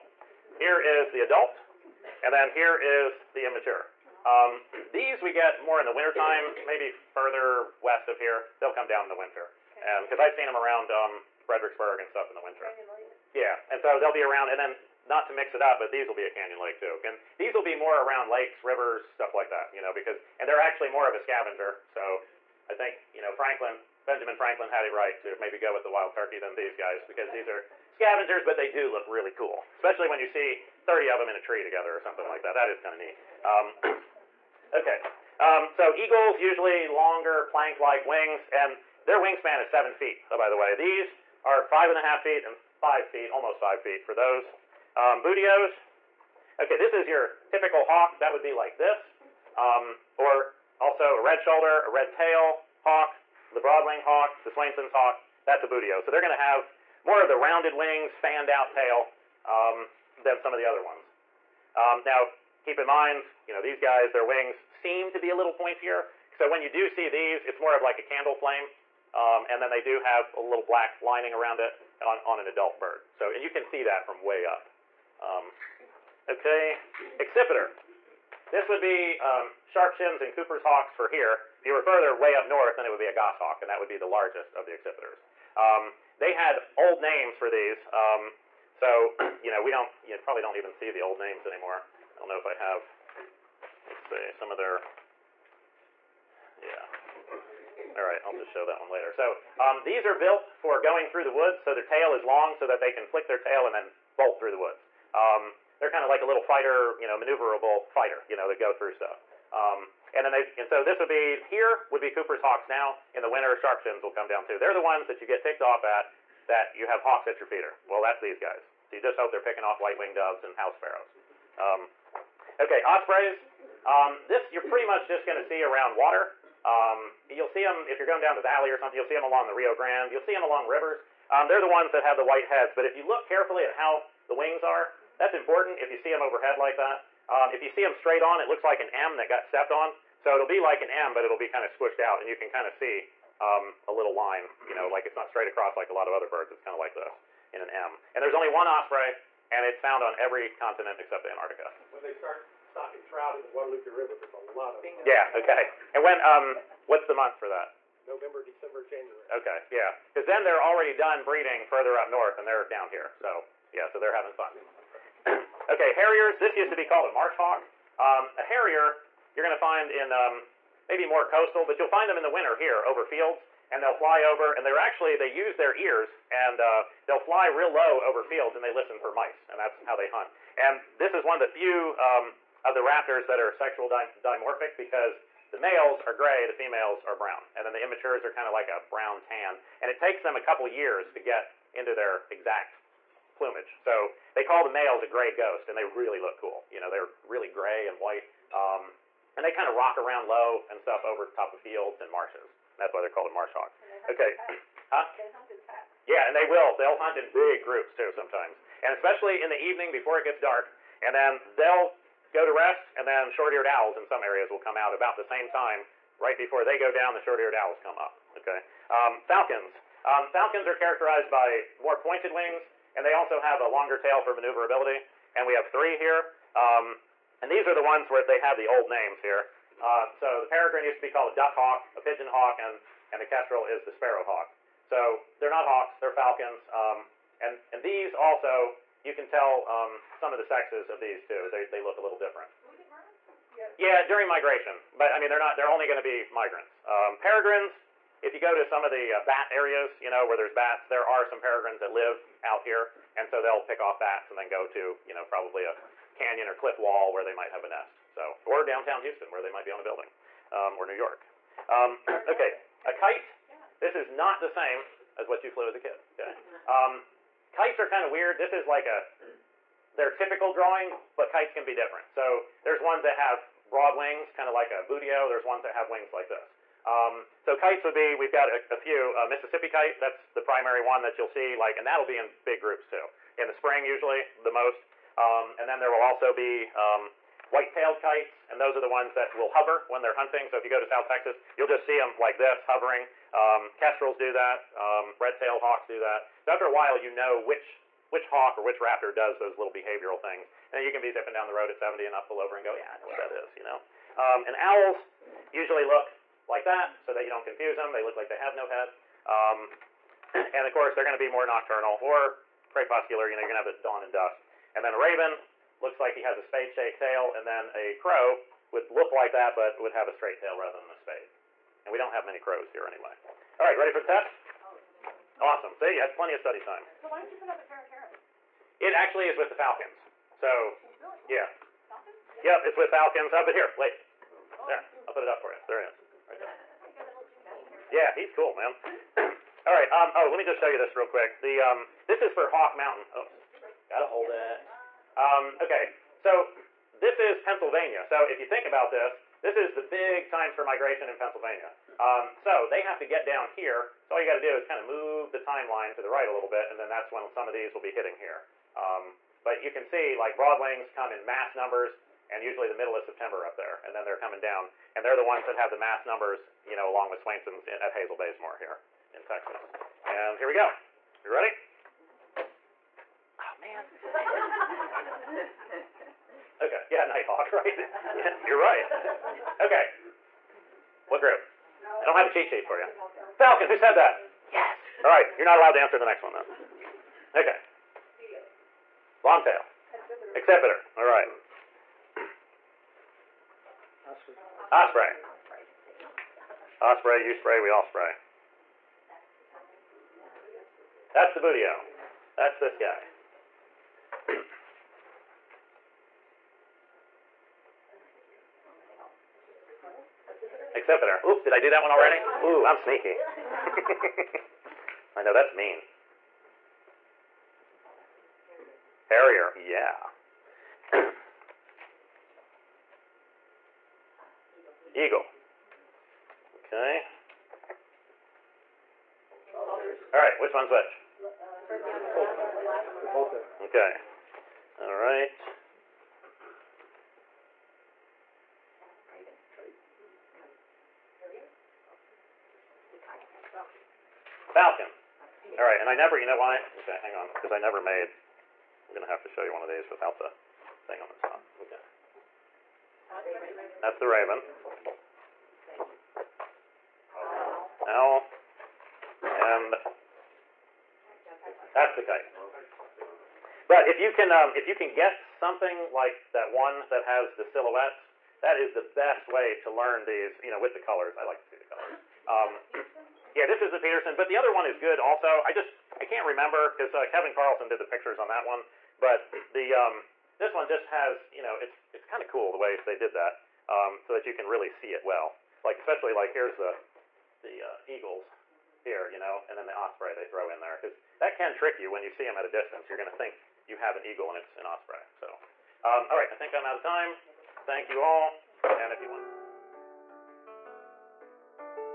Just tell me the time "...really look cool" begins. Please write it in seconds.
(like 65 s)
195 s.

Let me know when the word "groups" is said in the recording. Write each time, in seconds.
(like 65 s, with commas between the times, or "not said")
207 s, 282 s, 381 s.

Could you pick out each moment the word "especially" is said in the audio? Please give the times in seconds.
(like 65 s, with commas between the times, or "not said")
29 s, 208 s, 485 s.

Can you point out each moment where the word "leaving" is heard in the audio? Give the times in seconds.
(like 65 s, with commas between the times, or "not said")
not said.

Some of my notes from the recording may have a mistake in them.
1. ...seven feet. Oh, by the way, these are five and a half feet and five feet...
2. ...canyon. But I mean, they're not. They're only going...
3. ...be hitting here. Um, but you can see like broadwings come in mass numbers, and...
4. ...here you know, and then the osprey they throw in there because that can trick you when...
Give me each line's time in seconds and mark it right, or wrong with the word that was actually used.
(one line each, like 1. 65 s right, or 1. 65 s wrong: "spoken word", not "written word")
1. 39 s right
2. 244 s wrong: "migration", not "canyon"
3. 357 s right
4. 488 s right.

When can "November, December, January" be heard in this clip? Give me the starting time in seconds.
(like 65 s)
158 s.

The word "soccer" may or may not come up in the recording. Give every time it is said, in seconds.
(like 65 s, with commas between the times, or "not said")
not said.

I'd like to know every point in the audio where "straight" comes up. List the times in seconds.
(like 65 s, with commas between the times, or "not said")
137 s, 145 s, 320 s.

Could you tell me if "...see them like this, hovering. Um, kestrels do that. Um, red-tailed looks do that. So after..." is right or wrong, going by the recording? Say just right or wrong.
wrong.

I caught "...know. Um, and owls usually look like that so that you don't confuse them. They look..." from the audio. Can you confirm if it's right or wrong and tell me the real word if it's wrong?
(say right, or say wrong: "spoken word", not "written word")
right.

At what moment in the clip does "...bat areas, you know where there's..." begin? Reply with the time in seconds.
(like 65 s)
249 s.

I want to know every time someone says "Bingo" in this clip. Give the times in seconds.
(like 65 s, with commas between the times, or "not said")
154 s.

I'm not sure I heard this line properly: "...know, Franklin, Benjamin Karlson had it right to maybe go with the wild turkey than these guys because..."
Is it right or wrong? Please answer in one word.
wrong.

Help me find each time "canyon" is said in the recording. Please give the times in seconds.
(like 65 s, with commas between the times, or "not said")
16 s, 256 s.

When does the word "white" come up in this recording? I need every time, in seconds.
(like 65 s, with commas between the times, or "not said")
119 s, 132 s, 197 s, 287 s.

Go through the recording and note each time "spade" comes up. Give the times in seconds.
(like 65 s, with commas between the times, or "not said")
316 s, 320 s.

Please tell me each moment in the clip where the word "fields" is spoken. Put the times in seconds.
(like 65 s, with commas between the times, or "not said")
173 s, 178 s, 201 s.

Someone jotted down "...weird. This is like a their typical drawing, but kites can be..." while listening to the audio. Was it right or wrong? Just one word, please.
right.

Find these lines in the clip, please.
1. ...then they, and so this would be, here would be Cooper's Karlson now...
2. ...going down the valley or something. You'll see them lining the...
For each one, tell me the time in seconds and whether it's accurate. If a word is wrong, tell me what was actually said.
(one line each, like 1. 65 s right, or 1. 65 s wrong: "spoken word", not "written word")
1. 110 s wrong: "Hawks", not "Karlson"
2. 128 s wrong: "along", not "lining".